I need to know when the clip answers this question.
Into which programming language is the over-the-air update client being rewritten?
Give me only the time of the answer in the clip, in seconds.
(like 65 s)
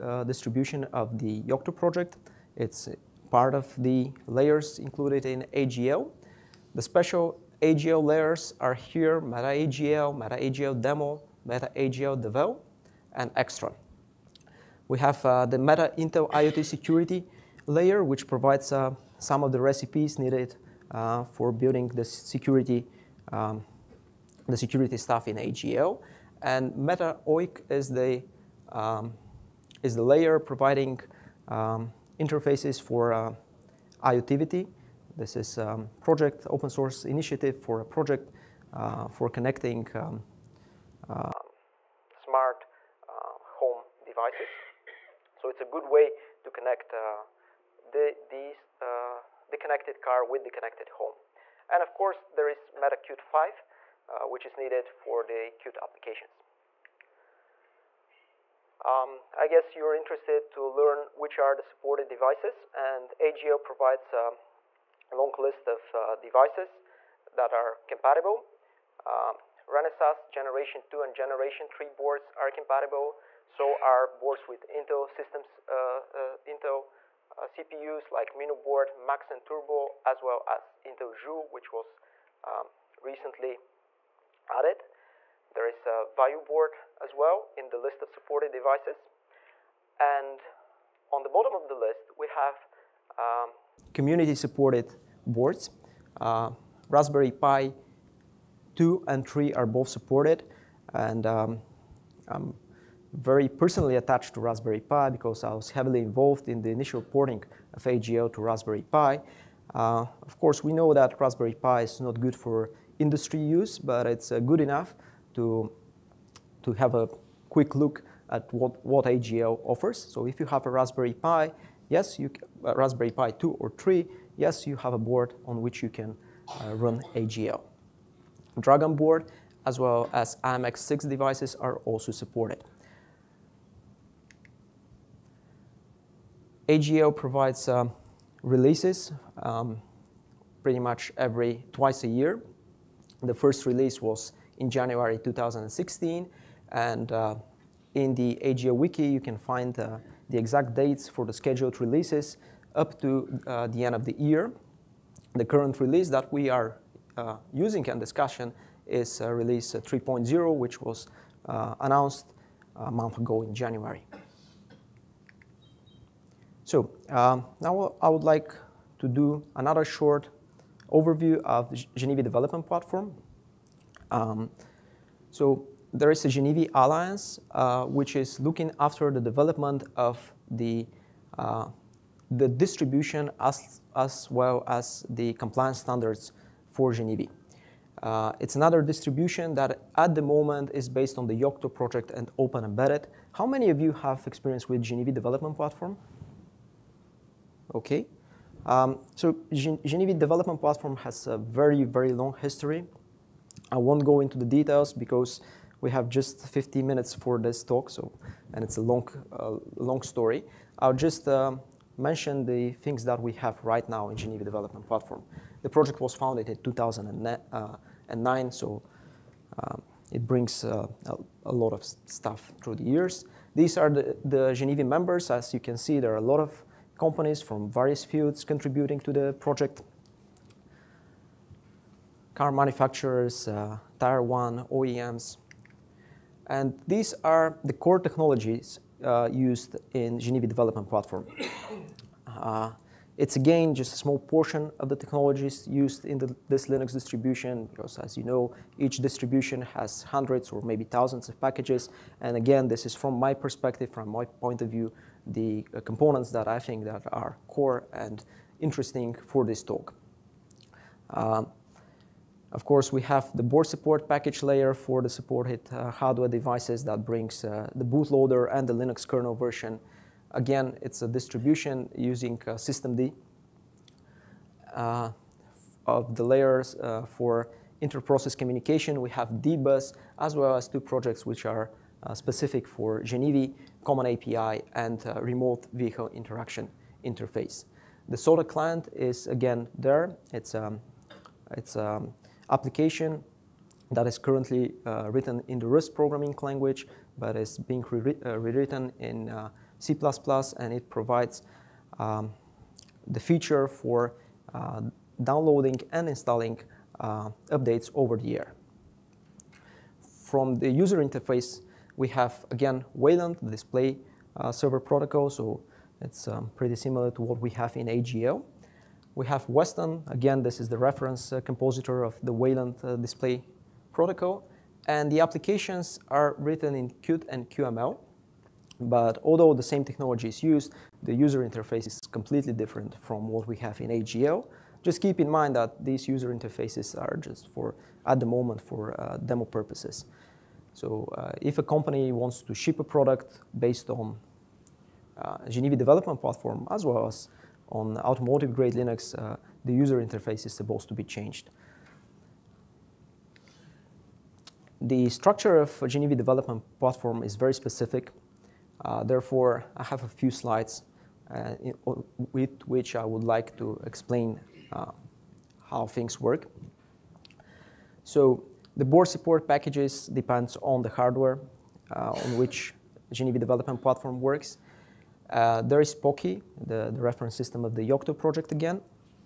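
299 s.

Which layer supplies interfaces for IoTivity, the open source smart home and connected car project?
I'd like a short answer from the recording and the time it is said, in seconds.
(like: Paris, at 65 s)
Meta OIC, at 26 s.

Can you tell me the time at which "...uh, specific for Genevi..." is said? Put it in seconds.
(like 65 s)
282 s.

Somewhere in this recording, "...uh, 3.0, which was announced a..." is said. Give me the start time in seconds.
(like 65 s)
159 s.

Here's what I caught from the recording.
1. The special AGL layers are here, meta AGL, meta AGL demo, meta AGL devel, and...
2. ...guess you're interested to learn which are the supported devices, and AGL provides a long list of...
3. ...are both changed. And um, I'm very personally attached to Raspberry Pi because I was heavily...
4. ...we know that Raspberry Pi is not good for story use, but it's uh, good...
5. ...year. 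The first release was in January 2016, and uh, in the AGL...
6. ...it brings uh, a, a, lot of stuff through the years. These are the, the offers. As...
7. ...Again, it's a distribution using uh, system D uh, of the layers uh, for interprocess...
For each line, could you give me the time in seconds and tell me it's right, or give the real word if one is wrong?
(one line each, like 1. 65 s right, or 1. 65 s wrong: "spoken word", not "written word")
1. 6 s right
2. 59 s right
3. 99 s wrong: "supported", not "changed"
4. 110 s wrong: "industry", not "story"
5. 142 s right
6. 220 s wrong: "members", not "offers"
7. 270 s right.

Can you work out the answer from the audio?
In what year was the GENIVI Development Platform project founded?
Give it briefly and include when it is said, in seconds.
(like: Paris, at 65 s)
2009, at 216 s.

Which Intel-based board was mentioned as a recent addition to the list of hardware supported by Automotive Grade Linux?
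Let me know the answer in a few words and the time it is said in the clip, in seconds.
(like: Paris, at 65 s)
Intel Joule, at 80 s.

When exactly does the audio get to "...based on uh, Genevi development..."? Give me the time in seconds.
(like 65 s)
343 s.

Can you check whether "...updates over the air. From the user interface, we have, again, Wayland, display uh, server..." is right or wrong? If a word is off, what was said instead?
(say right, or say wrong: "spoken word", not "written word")
right.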